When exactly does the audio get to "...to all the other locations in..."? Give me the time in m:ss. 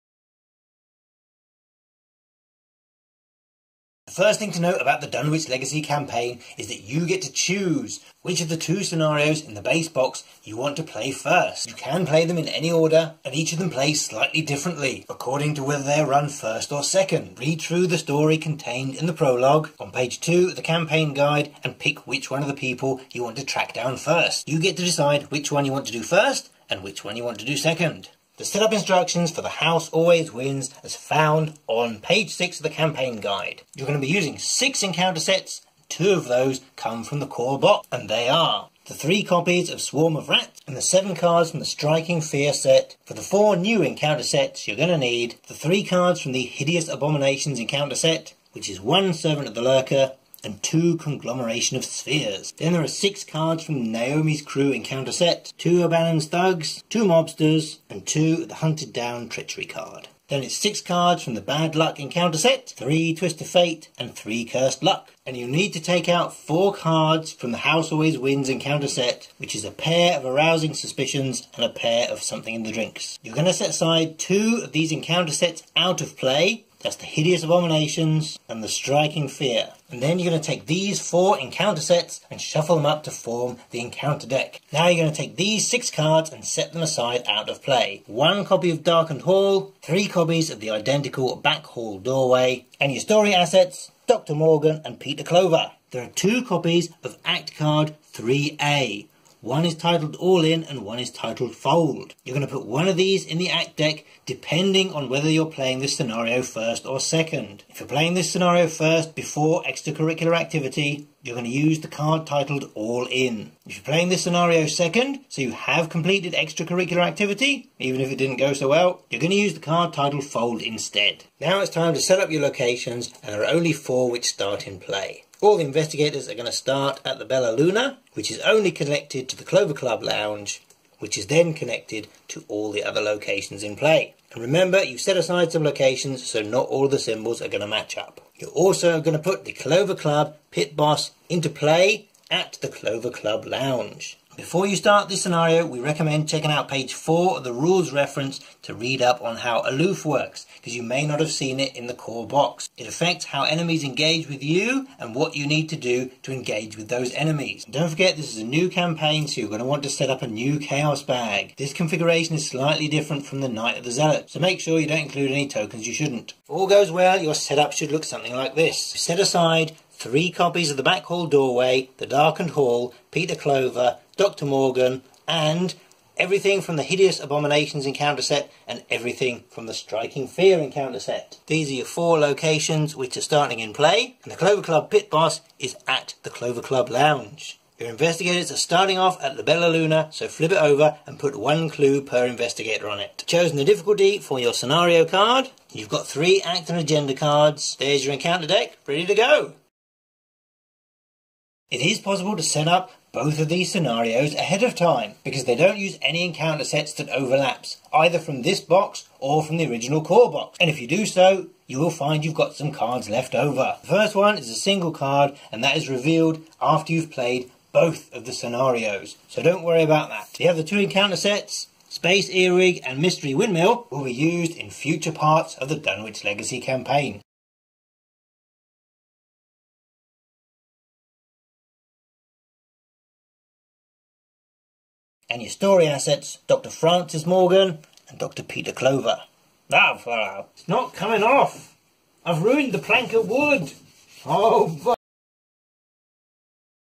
2:12.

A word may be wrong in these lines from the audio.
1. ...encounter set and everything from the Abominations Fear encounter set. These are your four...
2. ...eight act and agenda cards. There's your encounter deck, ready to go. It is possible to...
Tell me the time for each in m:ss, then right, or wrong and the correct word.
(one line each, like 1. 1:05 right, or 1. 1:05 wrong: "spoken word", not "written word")
1. 2:57 wrong: "Striking", not "Abominations"
2. 3:16 wrong: "three", not "eight".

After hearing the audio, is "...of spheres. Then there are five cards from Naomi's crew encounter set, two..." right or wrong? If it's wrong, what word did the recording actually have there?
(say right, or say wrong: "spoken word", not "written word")
wrong: "six", not "five".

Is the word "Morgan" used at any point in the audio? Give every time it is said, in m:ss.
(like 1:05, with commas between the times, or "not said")
1:34, 2:54, 3:57.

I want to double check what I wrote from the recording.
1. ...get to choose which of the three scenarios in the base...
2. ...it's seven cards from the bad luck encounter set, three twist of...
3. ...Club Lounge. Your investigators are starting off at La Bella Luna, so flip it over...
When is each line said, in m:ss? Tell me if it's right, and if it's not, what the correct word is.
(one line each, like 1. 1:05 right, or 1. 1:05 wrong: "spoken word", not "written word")
1. 0:07 wrong: "two", not "three"
2. 1:00 wrong: "six", not "seven"
3. 3:06 right.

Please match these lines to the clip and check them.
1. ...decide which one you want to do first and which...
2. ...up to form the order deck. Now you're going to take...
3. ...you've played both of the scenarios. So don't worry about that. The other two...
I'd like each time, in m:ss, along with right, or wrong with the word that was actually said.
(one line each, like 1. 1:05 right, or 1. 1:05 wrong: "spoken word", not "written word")
1. 0:24 right
2. 1:22 wrong: "encounter", not "order"
3. 3:36 right.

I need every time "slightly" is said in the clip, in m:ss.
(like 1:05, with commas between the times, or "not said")
0:14, 2:42.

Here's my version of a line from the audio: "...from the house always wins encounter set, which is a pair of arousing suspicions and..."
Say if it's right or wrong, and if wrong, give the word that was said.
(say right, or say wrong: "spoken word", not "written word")
right.